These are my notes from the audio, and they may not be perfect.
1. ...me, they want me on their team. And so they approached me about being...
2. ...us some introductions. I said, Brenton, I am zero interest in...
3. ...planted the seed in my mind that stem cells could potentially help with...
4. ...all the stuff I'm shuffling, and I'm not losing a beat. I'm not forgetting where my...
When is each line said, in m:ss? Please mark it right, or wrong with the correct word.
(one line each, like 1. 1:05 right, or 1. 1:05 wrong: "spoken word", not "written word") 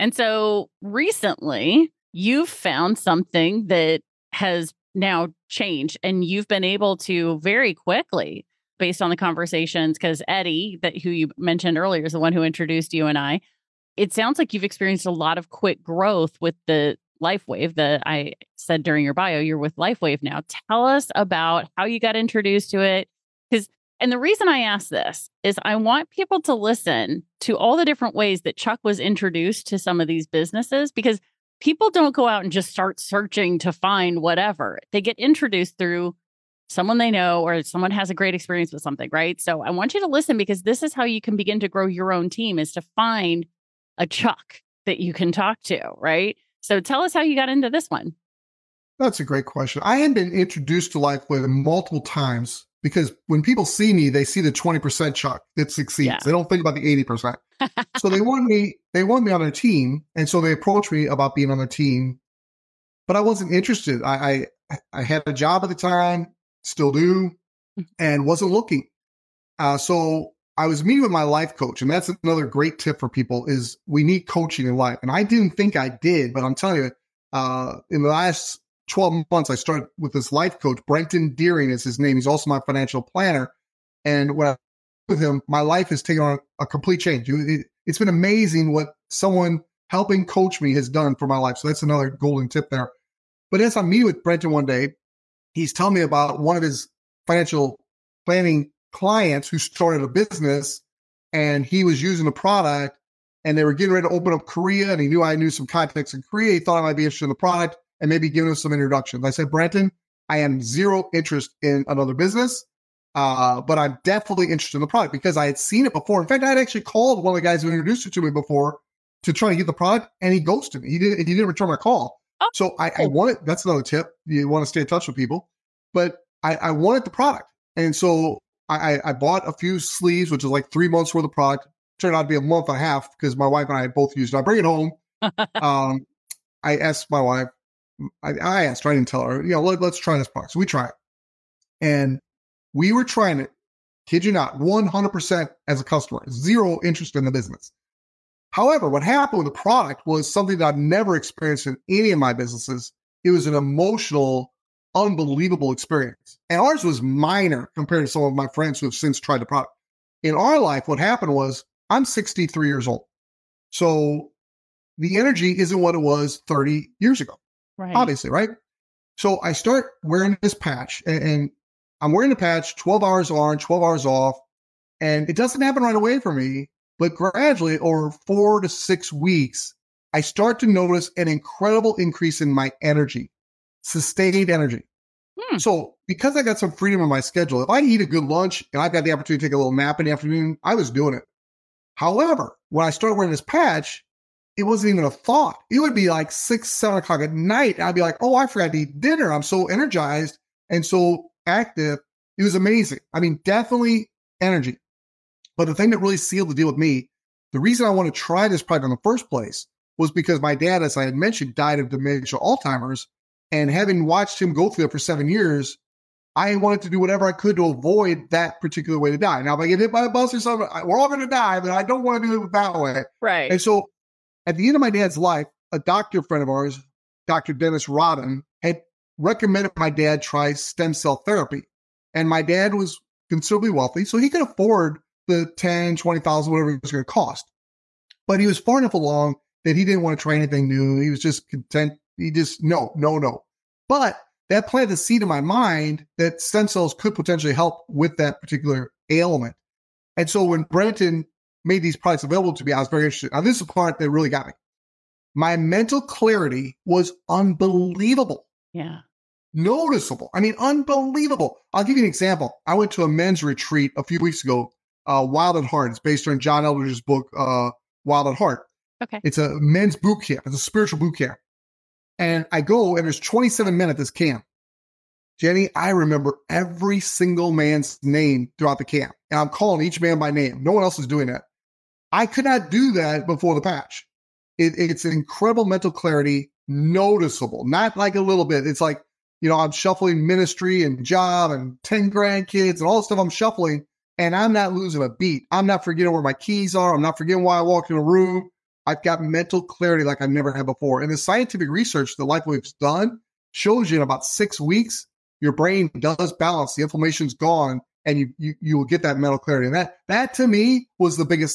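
1. 0:58 right
2. 1:48 right
3. 4:04 right
4. 4:52 right.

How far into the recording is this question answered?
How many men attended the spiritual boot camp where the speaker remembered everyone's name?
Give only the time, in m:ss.
4:33.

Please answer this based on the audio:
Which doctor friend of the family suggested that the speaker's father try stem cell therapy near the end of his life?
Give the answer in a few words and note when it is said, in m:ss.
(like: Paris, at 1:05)
Dr. Dennis Rodden, at 3:47.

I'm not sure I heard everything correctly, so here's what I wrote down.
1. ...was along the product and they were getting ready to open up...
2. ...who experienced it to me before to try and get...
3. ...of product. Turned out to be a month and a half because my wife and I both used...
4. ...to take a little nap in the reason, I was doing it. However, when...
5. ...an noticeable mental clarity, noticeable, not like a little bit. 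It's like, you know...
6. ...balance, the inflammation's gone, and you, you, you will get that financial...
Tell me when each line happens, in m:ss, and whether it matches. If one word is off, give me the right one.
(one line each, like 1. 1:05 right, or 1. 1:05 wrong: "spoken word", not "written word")
1. 1:41 wrong: "using", not "along"
2. 1:57 wrong: "introduced", not "experienced"
3. 2:11 right
4. 3:09 wrong: "afternoon", not "reason"
5. 4:45 wrong: "incredible", not "noticeable"
6. 5:06 wrong: "mental", not "financial".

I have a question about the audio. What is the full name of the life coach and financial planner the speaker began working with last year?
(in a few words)
Brenton Deering.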